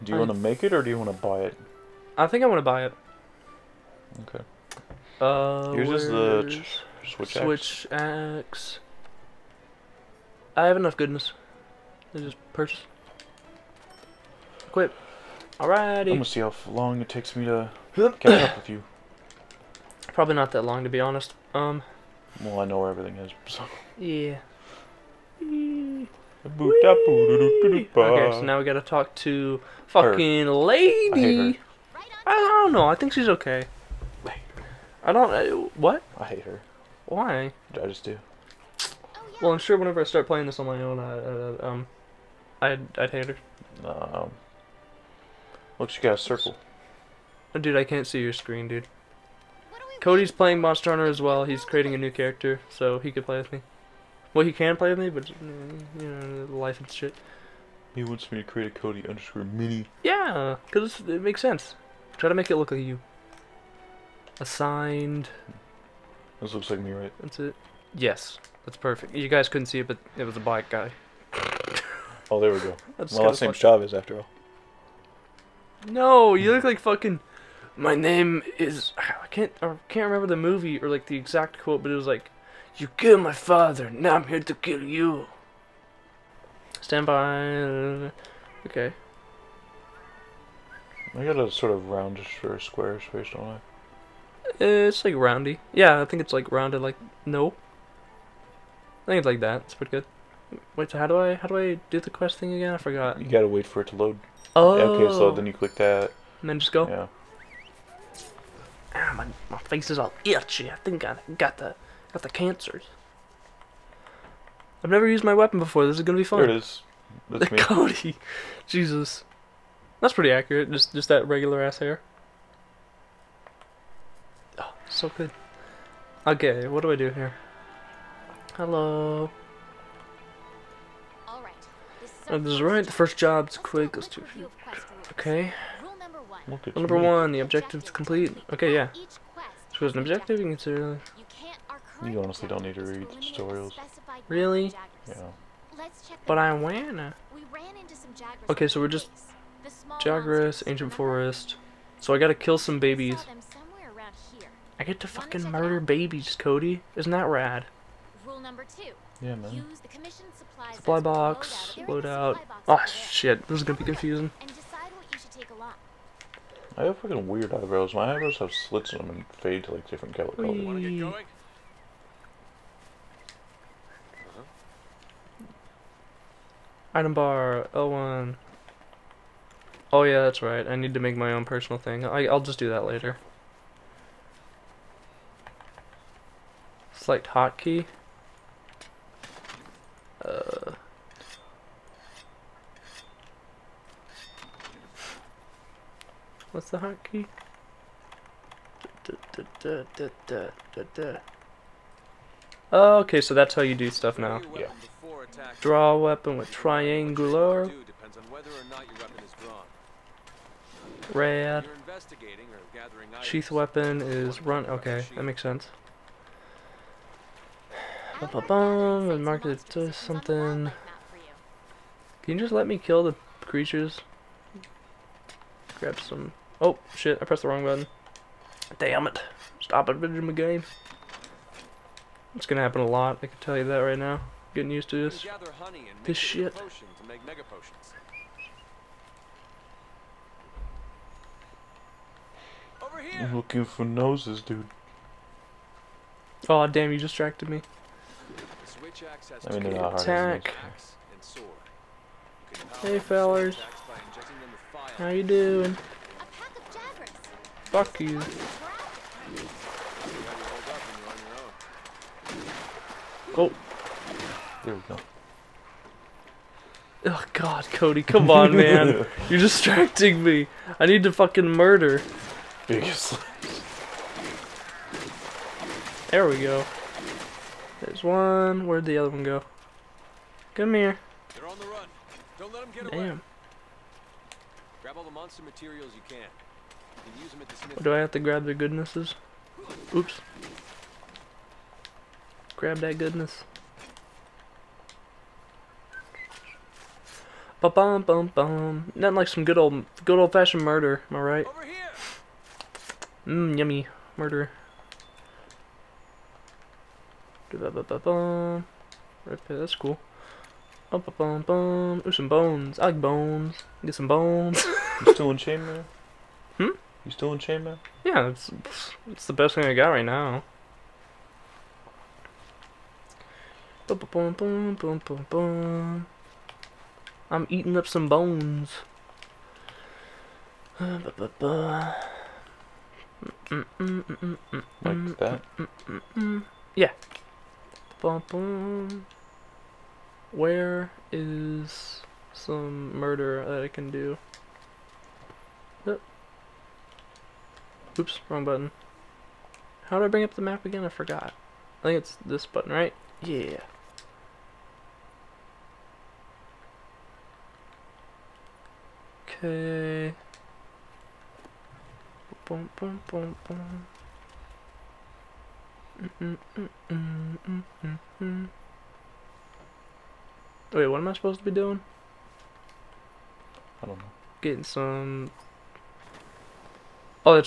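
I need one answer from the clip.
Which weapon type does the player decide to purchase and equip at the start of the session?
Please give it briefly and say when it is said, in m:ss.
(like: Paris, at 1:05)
Switch axe, at 0:06.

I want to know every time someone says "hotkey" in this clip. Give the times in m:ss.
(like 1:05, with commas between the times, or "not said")
3:07, 3:16.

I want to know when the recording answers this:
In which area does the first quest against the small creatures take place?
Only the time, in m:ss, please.
2:30.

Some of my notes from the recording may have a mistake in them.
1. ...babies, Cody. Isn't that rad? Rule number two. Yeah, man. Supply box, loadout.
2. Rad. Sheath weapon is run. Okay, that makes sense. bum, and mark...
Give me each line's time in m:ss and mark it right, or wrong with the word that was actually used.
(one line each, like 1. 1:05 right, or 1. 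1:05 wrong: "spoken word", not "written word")
1. 2:35 right
2. 3:31 right.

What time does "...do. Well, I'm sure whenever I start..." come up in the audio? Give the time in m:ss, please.
0:38.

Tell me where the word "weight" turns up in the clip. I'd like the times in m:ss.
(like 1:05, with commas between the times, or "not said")
not said.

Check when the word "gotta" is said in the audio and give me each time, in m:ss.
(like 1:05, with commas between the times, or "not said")
0:28, 1:43, 2:32.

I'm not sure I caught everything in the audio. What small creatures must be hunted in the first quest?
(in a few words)
Jagras.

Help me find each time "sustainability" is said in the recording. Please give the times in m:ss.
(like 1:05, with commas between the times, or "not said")
not said.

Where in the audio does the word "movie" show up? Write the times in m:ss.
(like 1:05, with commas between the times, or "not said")
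1:20.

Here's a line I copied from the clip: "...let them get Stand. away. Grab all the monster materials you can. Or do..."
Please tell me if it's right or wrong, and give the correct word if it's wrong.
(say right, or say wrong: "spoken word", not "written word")
wrong: "Damn", not "Stand".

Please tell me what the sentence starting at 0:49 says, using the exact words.
Cody's playing Monster Hunter as well.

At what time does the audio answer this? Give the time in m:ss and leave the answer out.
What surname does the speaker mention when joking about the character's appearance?
1:13.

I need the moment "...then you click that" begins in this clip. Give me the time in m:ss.
1:45.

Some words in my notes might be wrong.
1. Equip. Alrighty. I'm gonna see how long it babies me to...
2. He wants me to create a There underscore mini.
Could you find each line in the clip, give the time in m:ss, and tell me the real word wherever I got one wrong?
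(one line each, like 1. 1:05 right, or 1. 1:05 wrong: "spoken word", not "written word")
1. 0:14 wrong: "takes", not "babies"
2. 0:57 wrong: "Cody", not "There".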